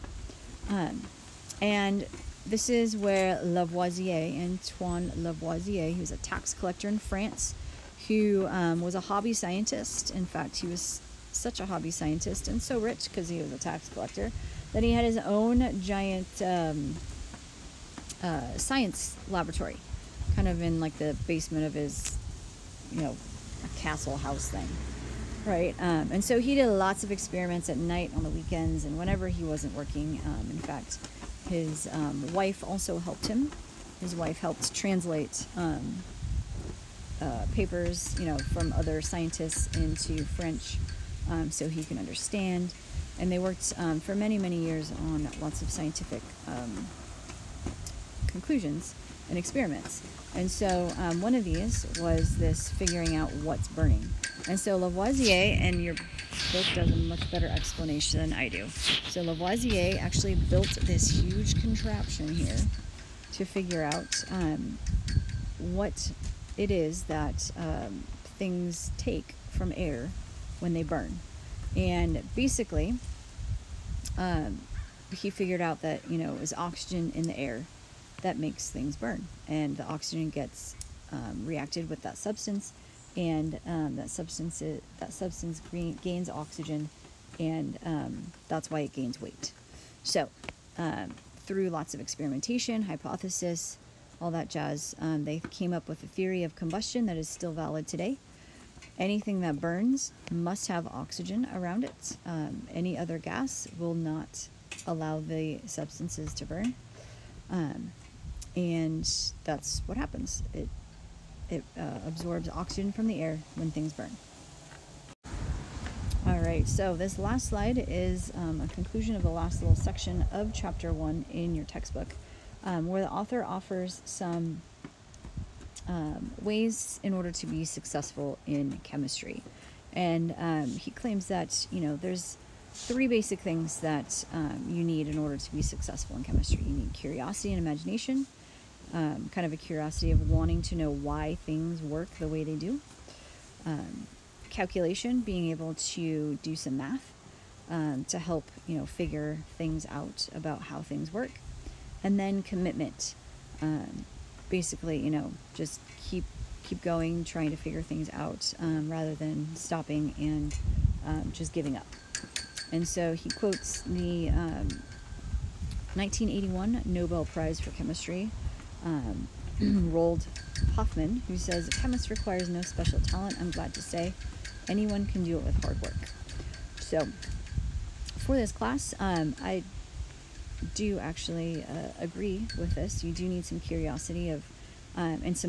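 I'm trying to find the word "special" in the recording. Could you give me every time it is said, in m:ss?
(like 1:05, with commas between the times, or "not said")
2:52.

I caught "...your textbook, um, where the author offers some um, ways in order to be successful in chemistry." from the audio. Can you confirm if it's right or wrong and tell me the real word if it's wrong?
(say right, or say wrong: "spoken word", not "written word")
right.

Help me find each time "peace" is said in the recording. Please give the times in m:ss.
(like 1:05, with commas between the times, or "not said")
not said.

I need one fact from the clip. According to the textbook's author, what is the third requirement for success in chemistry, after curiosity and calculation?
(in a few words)
Commitment.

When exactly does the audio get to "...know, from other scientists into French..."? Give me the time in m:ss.
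0:38.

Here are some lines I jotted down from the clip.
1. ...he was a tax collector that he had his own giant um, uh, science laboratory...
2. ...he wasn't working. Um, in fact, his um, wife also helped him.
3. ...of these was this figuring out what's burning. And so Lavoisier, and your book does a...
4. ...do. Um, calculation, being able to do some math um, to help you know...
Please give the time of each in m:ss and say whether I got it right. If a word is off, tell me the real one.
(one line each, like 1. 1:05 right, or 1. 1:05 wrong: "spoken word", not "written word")
1. 0:13 right
2. 0:29 right
3. 0:51 right
4. 2:22 right.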